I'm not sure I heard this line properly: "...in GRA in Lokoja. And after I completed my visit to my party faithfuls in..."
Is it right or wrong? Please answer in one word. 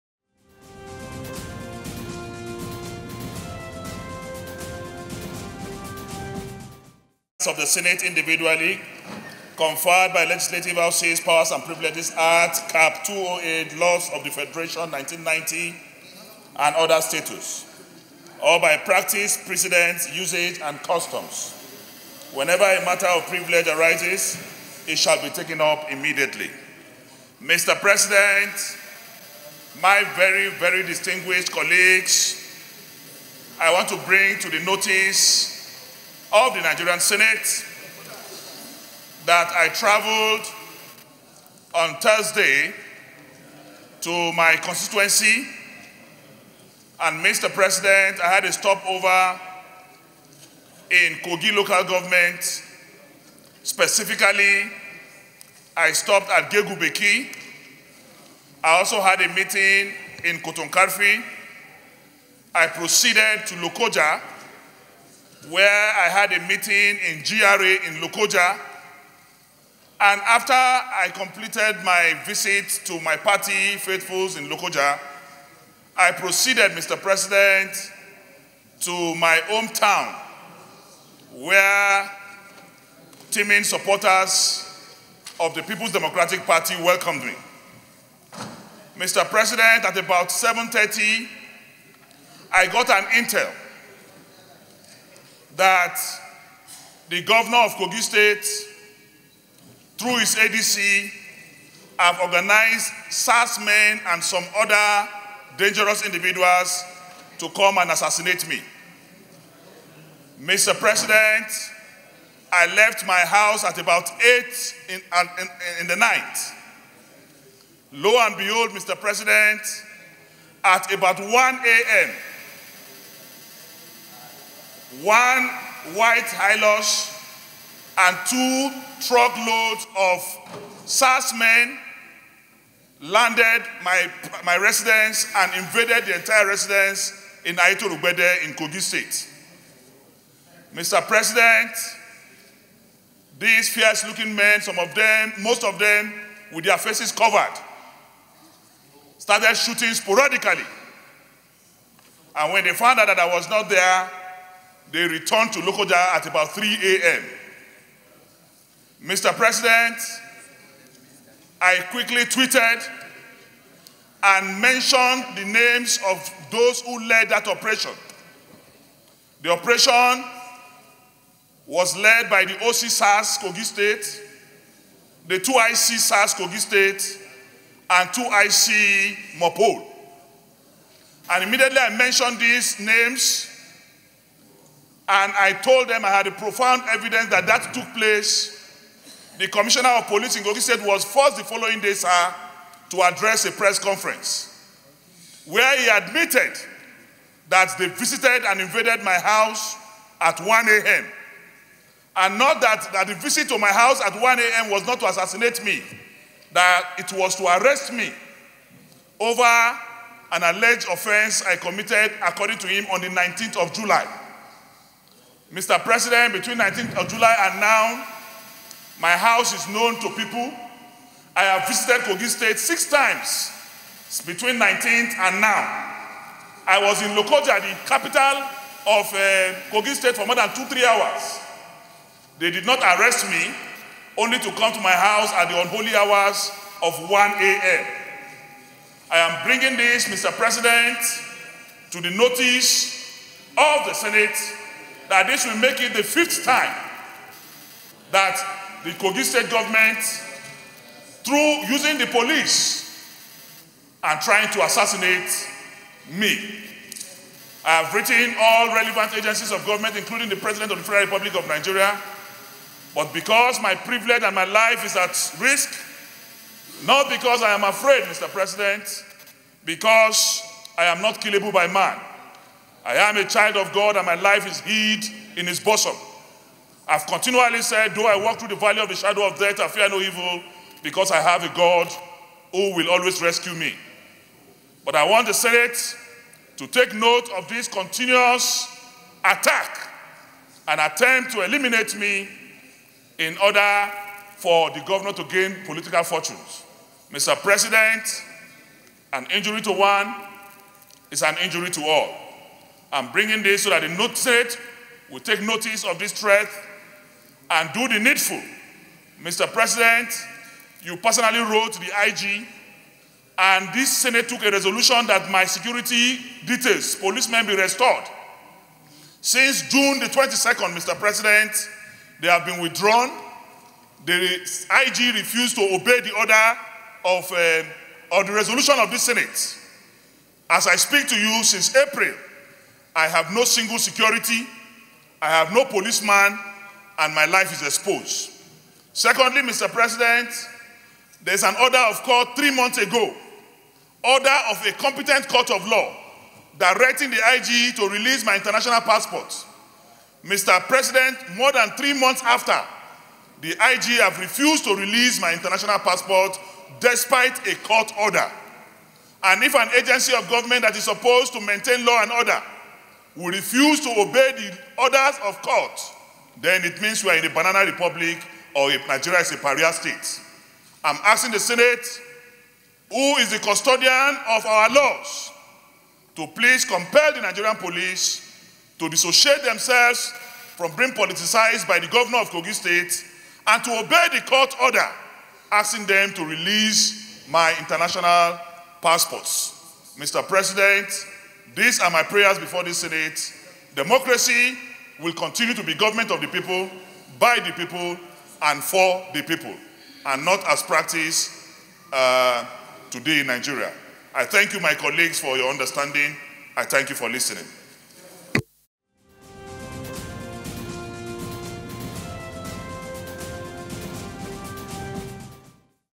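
right.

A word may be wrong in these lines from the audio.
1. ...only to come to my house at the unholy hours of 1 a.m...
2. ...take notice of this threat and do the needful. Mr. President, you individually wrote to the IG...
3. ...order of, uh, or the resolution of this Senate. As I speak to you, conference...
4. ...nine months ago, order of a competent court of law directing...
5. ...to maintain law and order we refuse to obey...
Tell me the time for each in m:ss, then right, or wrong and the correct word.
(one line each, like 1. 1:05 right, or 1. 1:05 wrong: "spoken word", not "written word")
1. 3:54 right
2. 5:05 wrong: "personally", not "individually"
3. 5:26 wrong: "since", not "conference"
4. 5:42 wrong: "three", not "nine"
5. 6:01 right.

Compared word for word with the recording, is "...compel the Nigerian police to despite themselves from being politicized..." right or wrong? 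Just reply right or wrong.
wrong.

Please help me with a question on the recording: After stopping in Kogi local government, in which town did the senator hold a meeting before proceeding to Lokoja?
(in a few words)
Kotonkarfe.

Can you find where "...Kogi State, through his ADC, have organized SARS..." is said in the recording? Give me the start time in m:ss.
1:37.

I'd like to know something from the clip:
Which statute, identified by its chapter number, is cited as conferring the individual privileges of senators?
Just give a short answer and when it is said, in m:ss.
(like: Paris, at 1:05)
CAP 208, at 0:12.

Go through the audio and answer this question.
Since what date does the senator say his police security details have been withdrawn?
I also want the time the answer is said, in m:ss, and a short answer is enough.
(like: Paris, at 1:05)
22 June, at 5:19.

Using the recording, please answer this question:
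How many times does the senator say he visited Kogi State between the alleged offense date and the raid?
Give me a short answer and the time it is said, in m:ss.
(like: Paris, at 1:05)
6, at 3:42.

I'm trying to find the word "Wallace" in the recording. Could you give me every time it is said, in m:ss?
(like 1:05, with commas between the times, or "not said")
not said.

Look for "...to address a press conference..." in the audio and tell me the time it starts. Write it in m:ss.
3:12.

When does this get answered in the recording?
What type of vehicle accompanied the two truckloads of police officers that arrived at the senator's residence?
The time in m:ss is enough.
2:05.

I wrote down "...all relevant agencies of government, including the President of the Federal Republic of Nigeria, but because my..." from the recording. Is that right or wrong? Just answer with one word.
right.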